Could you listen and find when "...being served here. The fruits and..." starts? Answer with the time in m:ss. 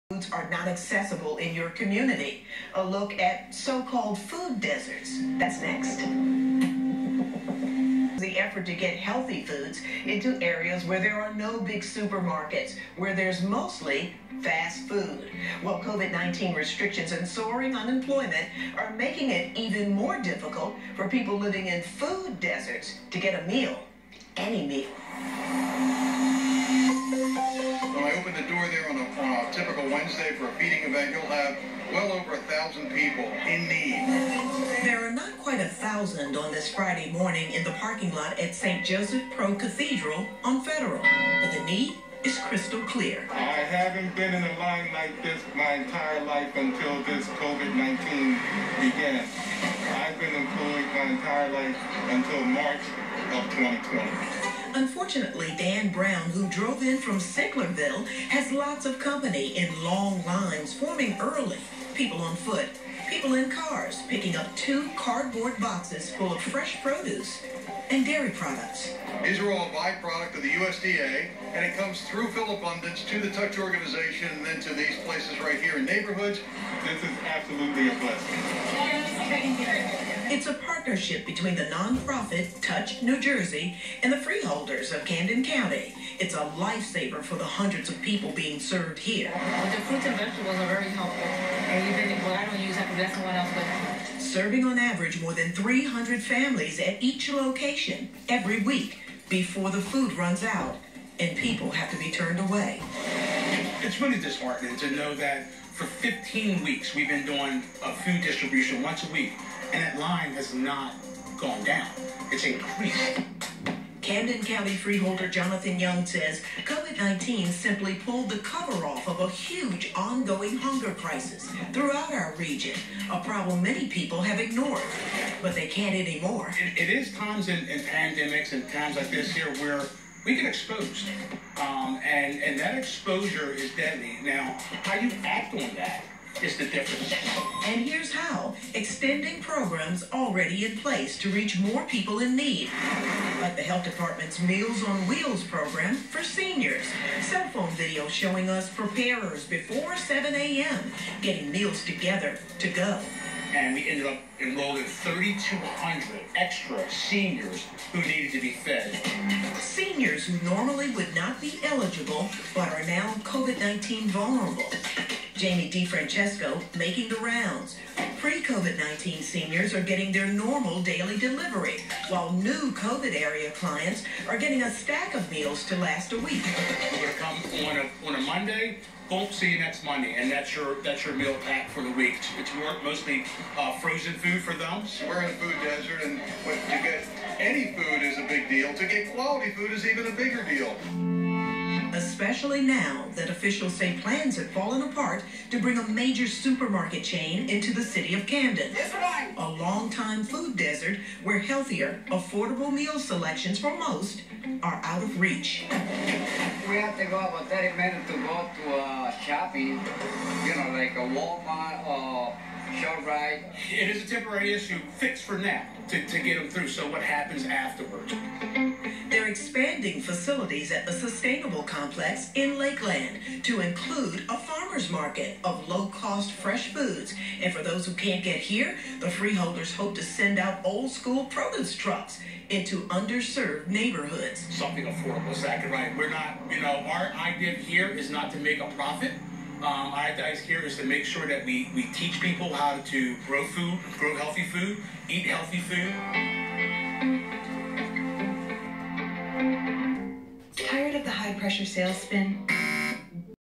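1:28.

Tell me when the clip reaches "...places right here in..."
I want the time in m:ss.
1:15.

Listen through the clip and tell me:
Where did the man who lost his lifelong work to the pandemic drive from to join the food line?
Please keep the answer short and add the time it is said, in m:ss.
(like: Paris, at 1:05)
Sicklerville, at 0:57.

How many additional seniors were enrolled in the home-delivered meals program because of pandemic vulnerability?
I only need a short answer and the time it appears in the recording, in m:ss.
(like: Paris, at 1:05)
3,200, at 2:34.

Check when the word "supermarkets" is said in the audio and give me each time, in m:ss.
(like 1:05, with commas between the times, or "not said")
0:11, 3:16.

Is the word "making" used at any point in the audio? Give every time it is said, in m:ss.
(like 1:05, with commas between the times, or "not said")
0:18, 2:46.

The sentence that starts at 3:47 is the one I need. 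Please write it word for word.
And for those who can't get here, the freeholders hope to send out old-school produce trucks into underserved neighborhoods.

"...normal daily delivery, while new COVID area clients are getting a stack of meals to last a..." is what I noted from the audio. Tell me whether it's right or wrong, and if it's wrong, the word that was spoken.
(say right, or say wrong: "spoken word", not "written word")
right.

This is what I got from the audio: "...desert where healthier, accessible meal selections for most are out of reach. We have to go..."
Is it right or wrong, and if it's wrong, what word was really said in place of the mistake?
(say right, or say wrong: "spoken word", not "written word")
wrong: "affordable", not "accessible".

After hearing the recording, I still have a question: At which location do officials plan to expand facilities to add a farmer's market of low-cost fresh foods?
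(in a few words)
Lakeland.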